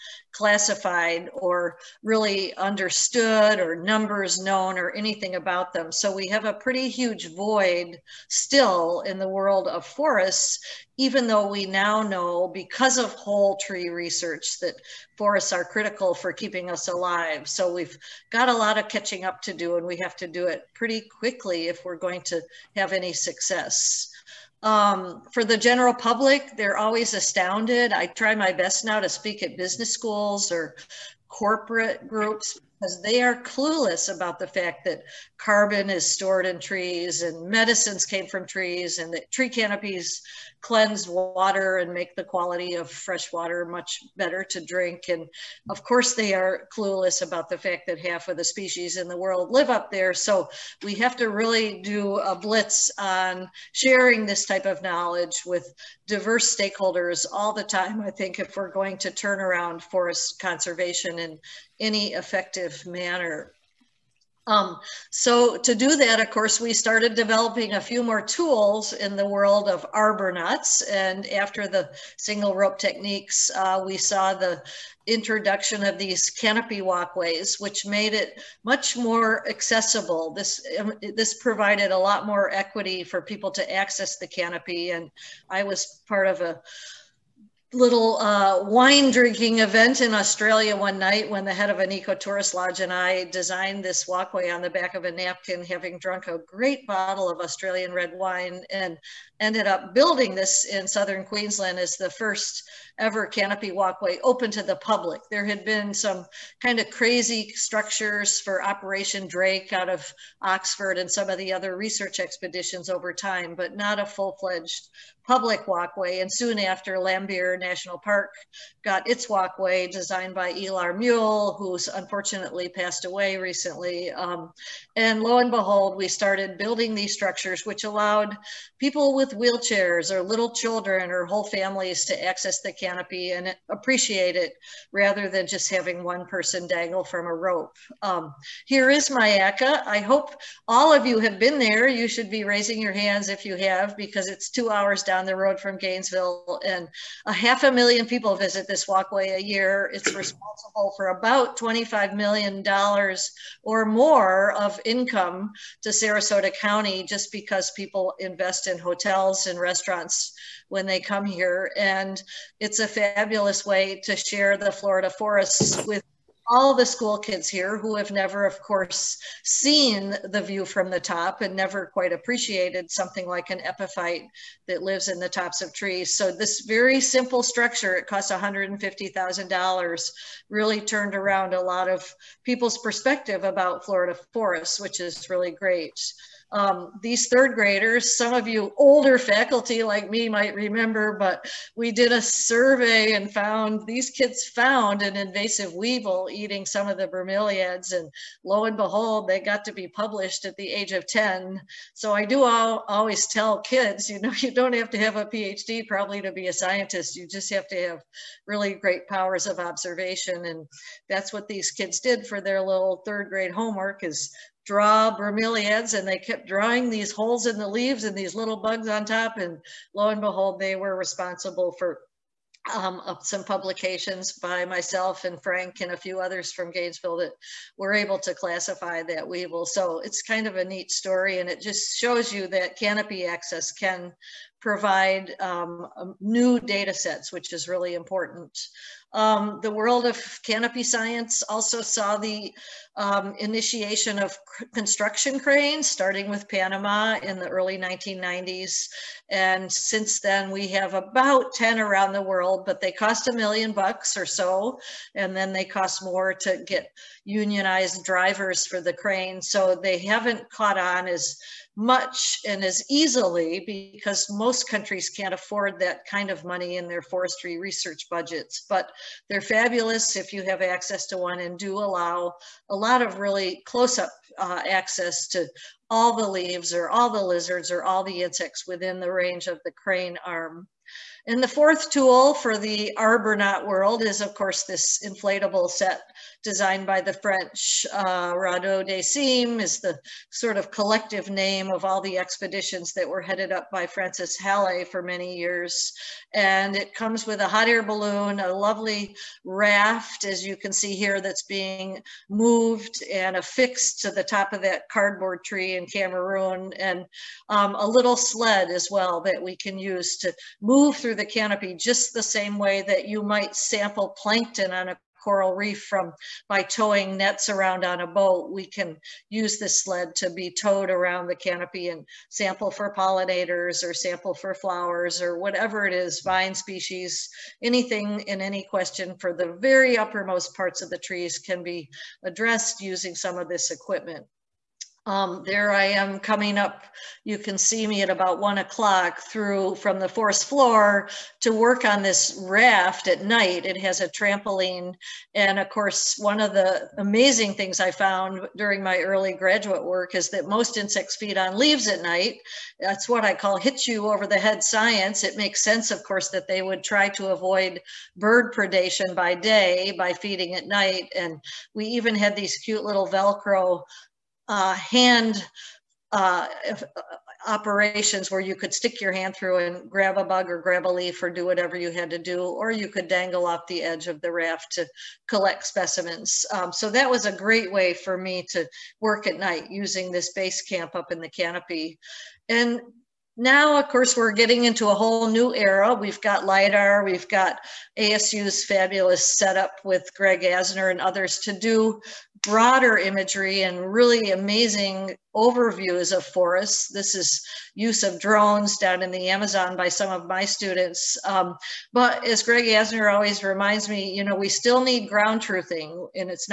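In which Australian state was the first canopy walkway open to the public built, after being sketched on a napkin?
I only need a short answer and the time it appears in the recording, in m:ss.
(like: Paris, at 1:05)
Southern Queensland, at 1:40.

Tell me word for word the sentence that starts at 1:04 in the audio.
Um, so to do that, of course, we started developing a few more tools in the world of arbornauts.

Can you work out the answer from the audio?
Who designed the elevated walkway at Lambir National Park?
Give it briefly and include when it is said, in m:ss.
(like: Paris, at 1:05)
Illar Muul, at 2:00.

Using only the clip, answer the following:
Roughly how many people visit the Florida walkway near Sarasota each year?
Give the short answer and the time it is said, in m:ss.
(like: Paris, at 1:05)
half a million, at 2:27.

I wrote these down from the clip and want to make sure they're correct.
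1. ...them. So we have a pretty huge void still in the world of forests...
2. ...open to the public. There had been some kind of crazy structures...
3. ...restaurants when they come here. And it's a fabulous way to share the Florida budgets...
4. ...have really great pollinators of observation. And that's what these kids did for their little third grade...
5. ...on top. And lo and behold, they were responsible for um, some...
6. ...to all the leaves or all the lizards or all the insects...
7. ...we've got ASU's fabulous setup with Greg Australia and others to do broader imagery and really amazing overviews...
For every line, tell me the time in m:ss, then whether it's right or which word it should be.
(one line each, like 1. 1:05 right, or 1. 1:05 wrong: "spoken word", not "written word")
1. 0:05 right
2. 1:44 right
3. 2:39 wrong: "forests", not "budgets"
4. 3:27 wrong: "powers", not "pollinators"
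5. 3:38 right
6. 4:35 right
7. 6:27 wrong: "Asner", not "Australia".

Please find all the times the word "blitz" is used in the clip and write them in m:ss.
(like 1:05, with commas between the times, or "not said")
0:52.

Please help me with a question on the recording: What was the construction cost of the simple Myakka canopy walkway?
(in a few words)
$150,000.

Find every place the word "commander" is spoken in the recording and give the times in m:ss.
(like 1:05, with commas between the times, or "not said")
not said.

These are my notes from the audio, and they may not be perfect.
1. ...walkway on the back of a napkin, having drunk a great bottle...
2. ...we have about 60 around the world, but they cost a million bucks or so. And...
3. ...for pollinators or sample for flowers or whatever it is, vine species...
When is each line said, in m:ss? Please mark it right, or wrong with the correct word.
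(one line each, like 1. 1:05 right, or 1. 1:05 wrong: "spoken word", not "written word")
1. 1:34 right
2. 4:10 wrong: "10", not "60"
3. 5:22 right.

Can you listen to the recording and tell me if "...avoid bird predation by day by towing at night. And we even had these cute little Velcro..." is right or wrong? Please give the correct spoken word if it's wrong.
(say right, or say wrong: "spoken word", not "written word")
wrong: "feeding", not "towing".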